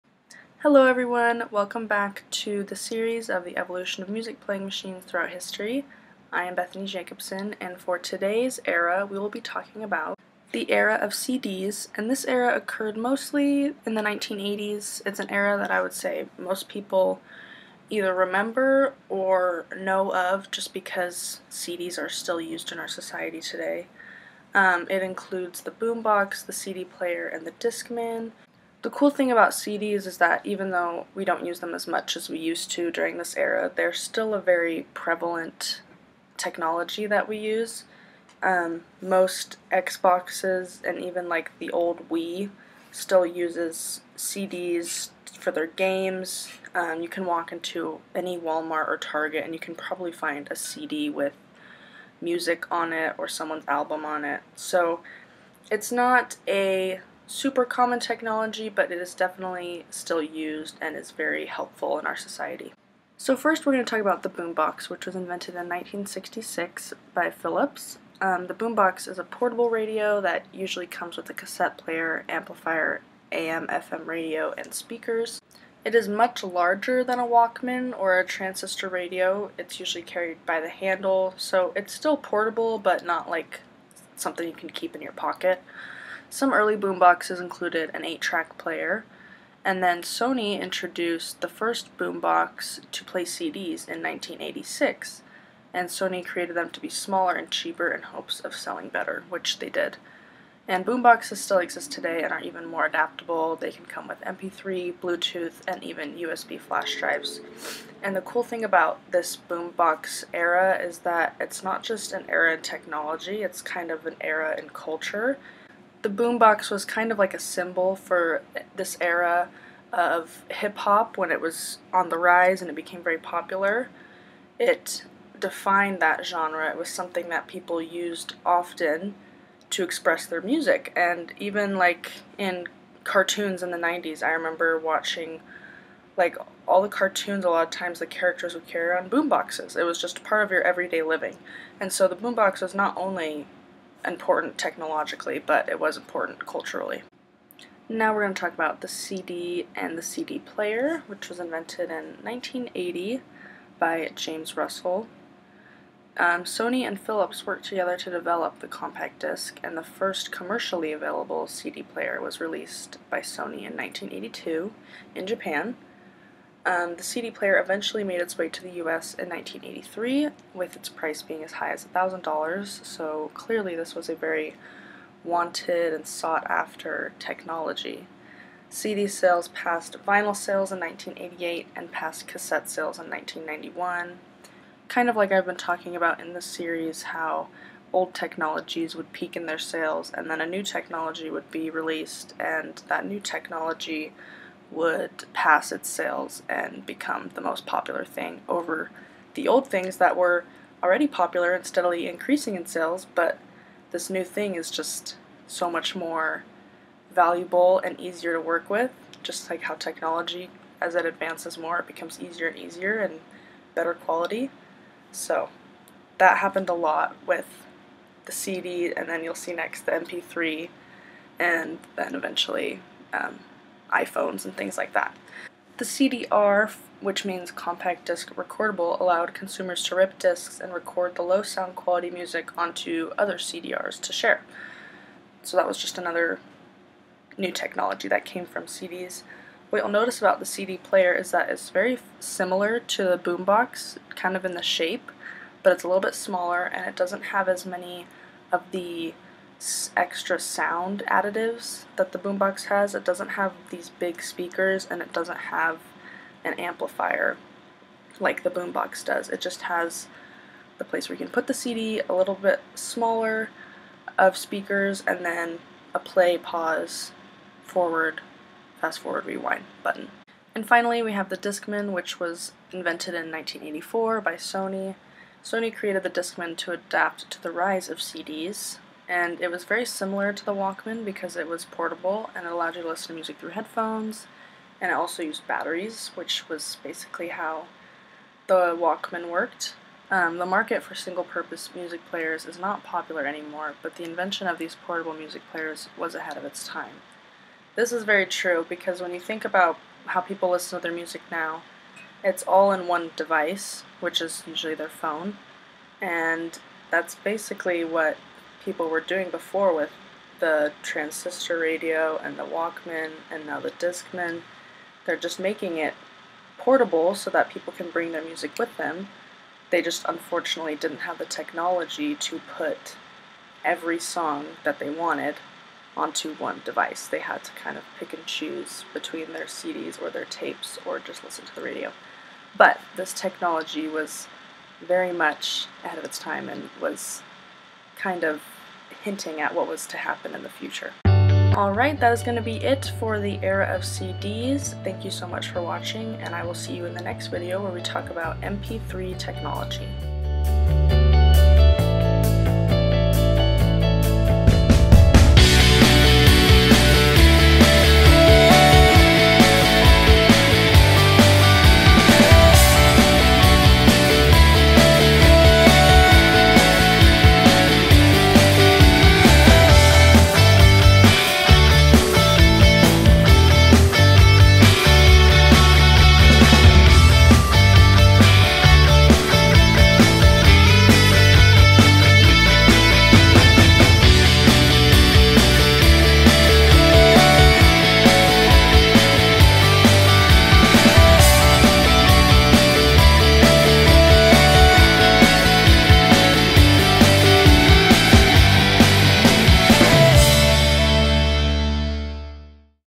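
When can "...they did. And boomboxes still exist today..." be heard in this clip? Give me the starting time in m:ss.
1:39.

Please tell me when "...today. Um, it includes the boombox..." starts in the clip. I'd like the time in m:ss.
0:23.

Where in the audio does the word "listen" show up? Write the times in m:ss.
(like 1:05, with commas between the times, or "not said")
4:42, 5:00, 5:31.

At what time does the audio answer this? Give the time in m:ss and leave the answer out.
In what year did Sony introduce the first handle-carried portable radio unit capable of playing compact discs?
1:34.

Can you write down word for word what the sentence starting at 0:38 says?
Um, most Xboxes and even like the old Wii still uses CDs for their games.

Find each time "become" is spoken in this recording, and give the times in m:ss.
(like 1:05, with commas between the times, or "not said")
3:16, 3:31.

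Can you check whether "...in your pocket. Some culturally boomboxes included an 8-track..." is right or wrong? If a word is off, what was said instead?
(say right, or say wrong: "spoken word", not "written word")
wrong: "early", not "culturally".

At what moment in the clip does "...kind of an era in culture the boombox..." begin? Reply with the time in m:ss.
1:53.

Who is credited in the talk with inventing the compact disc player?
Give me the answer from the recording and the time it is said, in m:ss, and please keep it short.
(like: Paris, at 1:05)
James Russell, at 2:34.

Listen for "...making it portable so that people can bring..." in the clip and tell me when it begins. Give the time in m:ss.
5:15.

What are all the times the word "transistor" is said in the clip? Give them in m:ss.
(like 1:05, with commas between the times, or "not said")
1:18, 5:10.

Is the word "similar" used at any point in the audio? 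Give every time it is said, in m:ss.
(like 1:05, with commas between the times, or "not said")
4:02, 4:39.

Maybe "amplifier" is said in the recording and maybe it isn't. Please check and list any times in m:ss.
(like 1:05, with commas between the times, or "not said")
1:12, 4:16.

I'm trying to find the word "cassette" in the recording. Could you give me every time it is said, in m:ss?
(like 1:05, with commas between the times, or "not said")
1:11, 3:02.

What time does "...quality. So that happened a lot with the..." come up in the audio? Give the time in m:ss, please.
3:33.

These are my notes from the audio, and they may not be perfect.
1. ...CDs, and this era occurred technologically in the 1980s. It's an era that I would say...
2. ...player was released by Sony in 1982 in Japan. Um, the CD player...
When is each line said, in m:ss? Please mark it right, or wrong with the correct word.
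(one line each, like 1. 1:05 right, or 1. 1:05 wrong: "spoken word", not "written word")
1. 0:11 wrong: "mostly", not "technologically"
2. 2:41 right.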